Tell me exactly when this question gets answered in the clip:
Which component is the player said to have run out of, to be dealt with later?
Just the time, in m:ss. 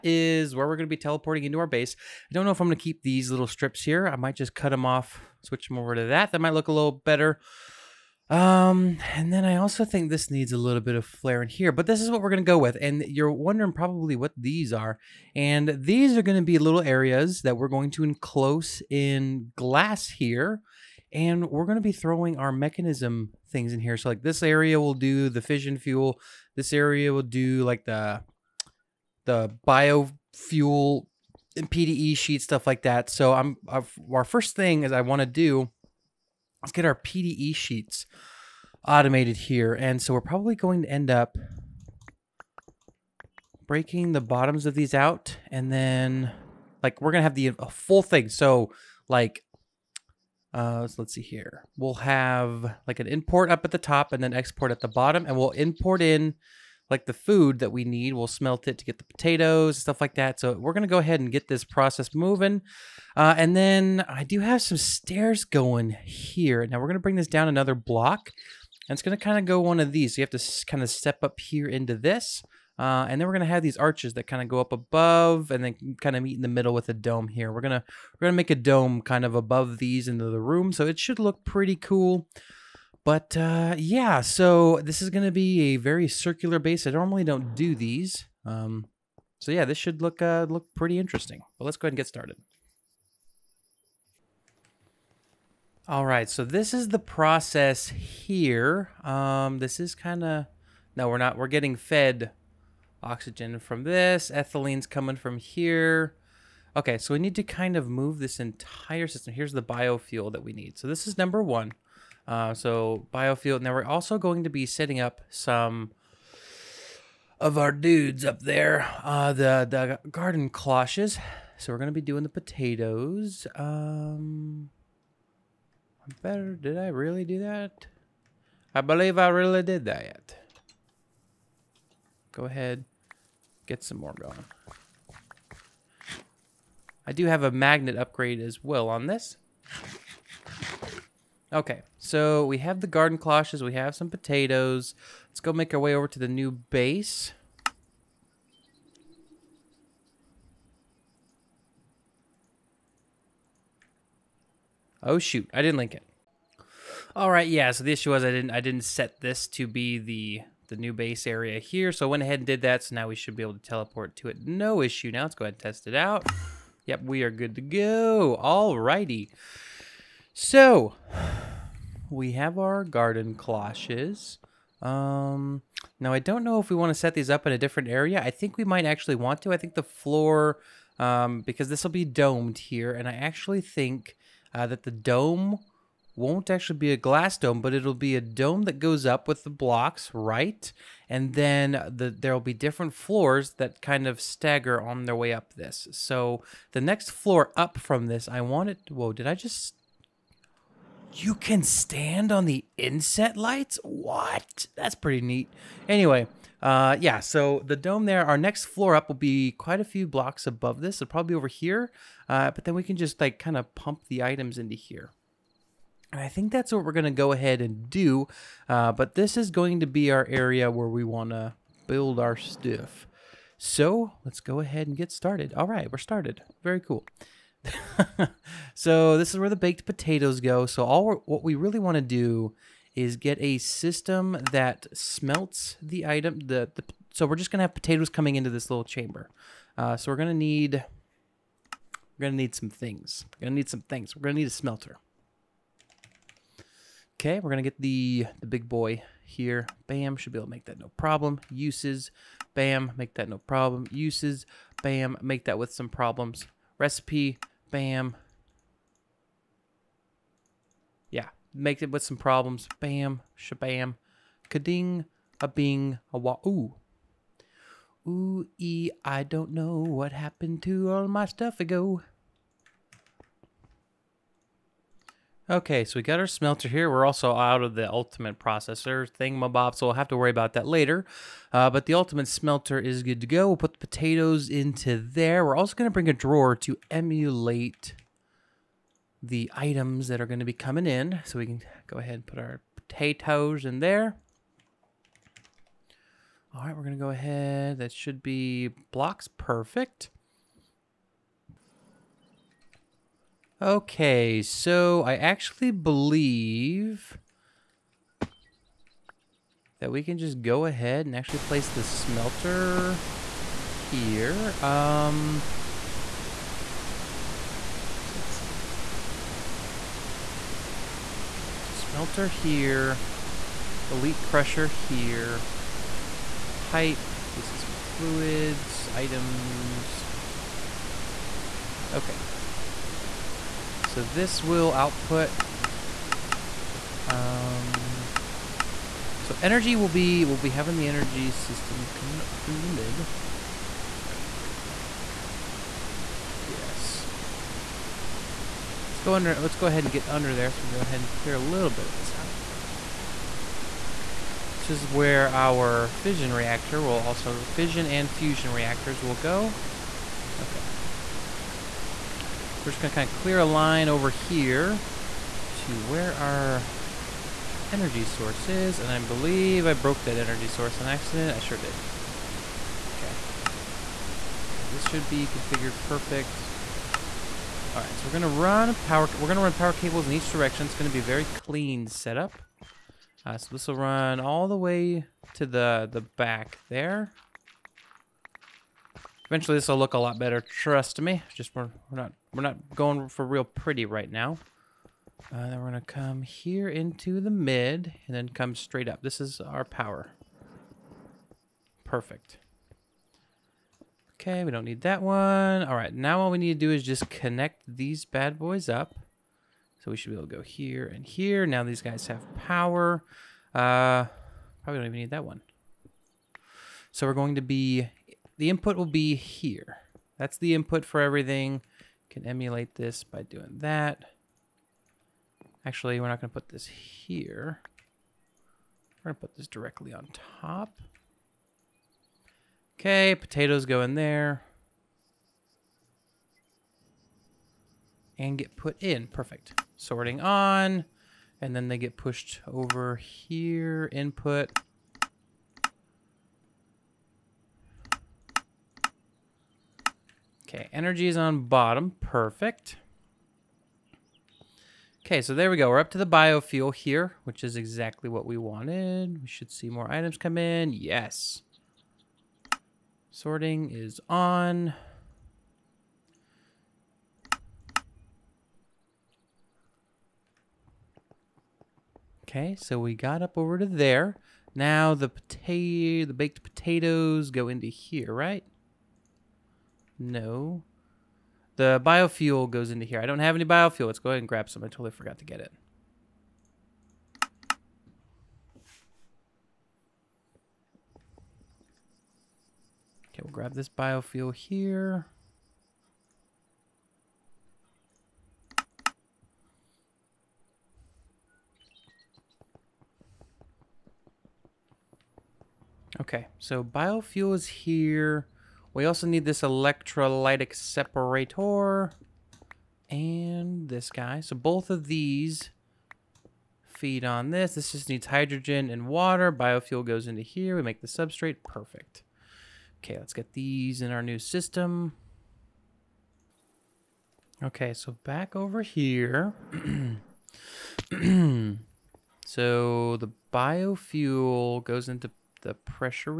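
4:37.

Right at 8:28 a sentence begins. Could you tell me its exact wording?
We also need this electrolytic separator and this guy.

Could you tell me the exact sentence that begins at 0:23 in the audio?
So like this area will do the fission fuel.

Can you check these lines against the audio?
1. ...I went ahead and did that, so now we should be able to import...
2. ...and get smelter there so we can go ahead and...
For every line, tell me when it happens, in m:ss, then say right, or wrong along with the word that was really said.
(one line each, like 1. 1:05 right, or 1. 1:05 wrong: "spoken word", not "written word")
1. 2:42 wrong: "teleport", not "import"
2. 5:49 wrong: "under", not "smelter".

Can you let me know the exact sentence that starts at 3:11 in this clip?
And then the, there'll be different floors that kind of stagger on their way up this.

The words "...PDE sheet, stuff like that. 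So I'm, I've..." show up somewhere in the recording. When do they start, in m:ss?
0:31.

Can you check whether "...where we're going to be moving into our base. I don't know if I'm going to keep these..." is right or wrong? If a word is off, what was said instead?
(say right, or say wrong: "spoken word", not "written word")
wrong: "teleporting", not "moving".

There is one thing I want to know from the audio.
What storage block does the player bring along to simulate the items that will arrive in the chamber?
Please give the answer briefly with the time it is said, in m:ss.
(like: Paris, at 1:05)
A drawer, at 4:46.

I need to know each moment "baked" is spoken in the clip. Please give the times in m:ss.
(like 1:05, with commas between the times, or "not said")
3:49, 7:56.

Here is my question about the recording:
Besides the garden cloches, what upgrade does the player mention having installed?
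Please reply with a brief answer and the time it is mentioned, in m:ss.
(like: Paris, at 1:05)
Magnet upgrade, at 2:17.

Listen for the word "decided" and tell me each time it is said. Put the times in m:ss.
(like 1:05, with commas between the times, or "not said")
not said.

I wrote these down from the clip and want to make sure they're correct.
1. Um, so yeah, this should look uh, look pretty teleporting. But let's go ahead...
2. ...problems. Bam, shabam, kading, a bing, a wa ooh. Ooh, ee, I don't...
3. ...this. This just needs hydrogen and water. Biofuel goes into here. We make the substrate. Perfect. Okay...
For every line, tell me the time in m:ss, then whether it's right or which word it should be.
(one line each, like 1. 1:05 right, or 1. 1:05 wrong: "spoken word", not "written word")
1. 1:28 wrong: "interesting", not "teleporting"
2. 4:22 right
3. 8:37 right.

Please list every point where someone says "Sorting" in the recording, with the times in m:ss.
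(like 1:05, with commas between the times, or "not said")
7:19, 7:43.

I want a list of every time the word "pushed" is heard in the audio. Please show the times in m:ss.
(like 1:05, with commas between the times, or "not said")
7:21.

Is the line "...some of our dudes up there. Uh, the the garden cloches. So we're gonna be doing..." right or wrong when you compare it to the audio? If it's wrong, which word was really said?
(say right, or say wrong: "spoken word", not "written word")
right.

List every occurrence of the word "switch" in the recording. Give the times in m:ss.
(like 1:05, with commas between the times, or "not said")
0:05.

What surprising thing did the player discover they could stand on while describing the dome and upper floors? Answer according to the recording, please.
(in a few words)
Inset lights.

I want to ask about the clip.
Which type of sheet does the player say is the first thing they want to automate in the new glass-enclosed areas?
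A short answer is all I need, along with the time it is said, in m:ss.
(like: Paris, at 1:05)
PDE sheets, at 0:36.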